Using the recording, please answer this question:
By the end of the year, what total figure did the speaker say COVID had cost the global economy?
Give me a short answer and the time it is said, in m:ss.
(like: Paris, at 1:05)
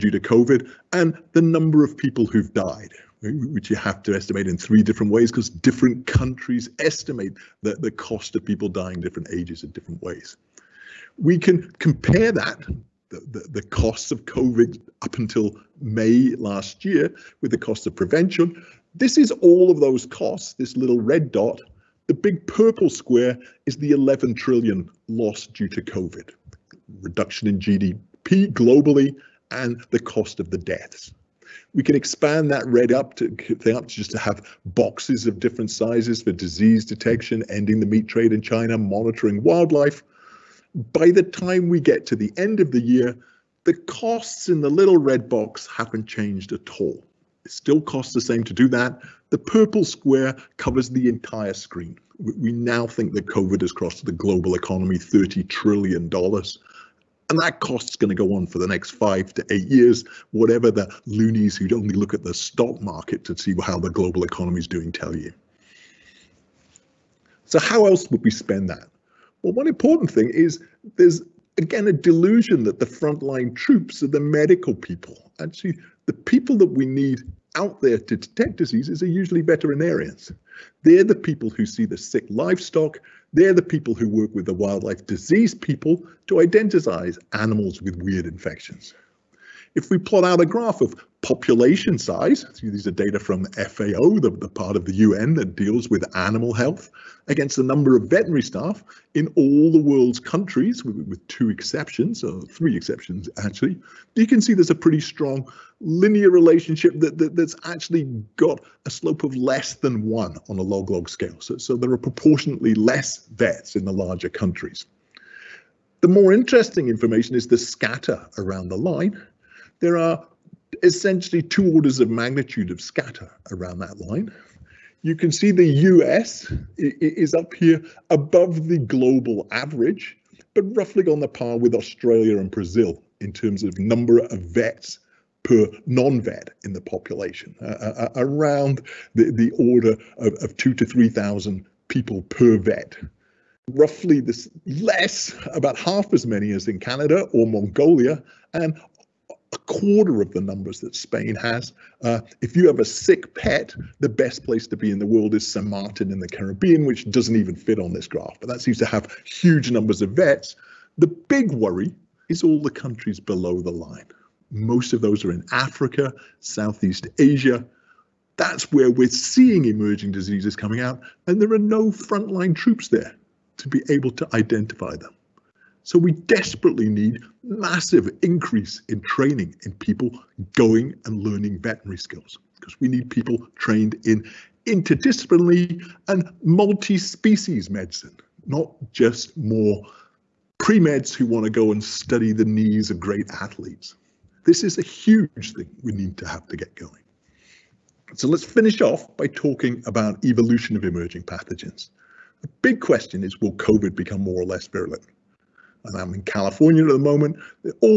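$30 trillion, at 0:54.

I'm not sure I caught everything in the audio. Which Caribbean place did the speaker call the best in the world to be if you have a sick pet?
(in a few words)
San Martin.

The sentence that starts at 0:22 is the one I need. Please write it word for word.
The big purple square is the 11 trillion loss due to COVID, reduction in GDP globally, and the cost of the deaths.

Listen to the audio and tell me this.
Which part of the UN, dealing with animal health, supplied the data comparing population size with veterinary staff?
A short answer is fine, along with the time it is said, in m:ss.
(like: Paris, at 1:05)
FAO, at 1:33.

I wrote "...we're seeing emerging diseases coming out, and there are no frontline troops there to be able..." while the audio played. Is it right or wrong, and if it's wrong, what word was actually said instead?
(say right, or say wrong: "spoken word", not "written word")
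right.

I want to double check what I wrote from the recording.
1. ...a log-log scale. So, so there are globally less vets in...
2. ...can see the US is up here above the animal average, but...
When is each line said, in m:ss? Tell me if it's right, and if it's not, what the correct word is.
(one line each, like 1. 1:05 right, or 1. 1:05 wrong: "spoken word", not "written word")
1. 1:50 wrong: "proportionately", not "globally"
2. 2:05 wrong: "global", not "animal".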